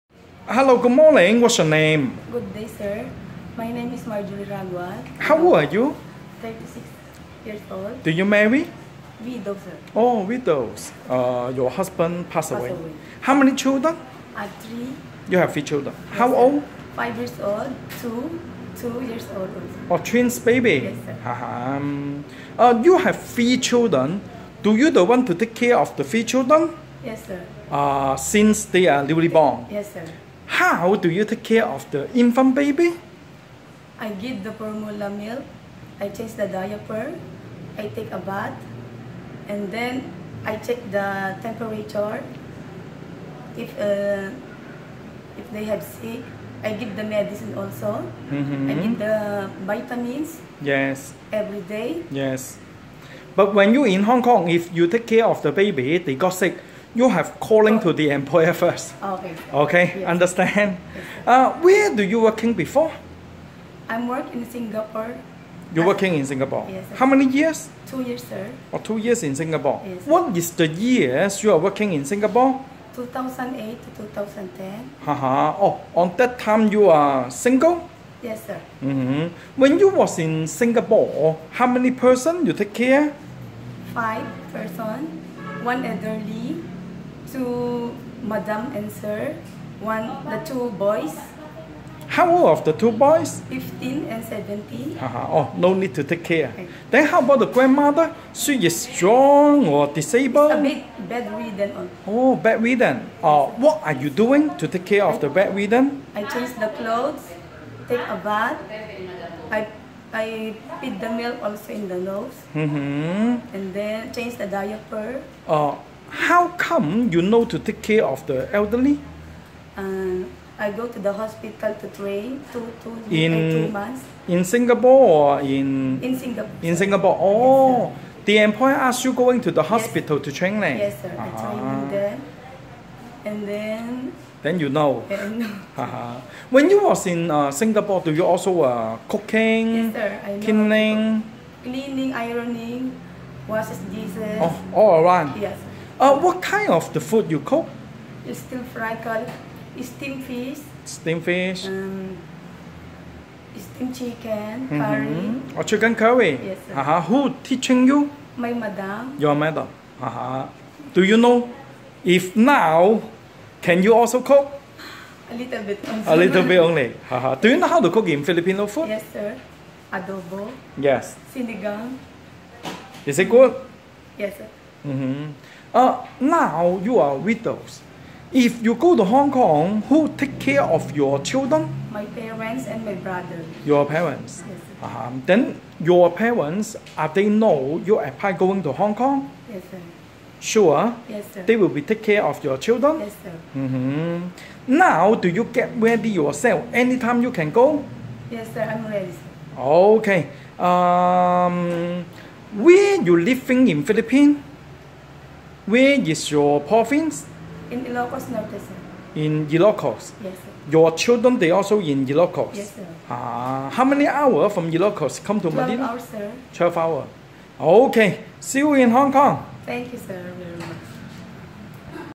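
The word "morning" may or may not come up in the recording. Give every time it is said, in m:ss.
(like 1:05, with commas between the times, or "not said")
0:00.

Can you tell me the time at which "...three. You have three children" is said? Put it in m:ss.
0:14.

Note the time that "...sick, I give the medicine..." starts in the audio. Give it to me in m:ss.
0:45.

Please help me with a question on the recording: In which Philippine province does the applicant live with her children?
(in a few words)
Ilocos Norte.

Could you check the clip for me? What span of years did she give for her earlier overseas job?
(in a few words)
2008 to 2010.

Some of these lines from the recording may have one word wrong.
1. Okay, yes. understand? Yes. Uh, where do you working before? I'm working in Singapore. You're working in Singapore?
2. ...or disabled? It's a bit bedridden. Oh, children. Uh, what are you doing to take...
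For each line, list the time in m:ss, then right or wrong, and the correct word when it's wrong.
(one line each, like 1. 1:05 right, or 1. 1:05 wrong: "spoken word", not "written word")
1. 0:59 right
2. 1:39 wrong: "bedridden", not "children".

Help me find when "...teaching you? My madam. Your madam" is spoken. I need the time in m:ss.
2:37.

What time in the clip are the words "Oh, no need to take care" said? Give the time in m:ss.
1:35.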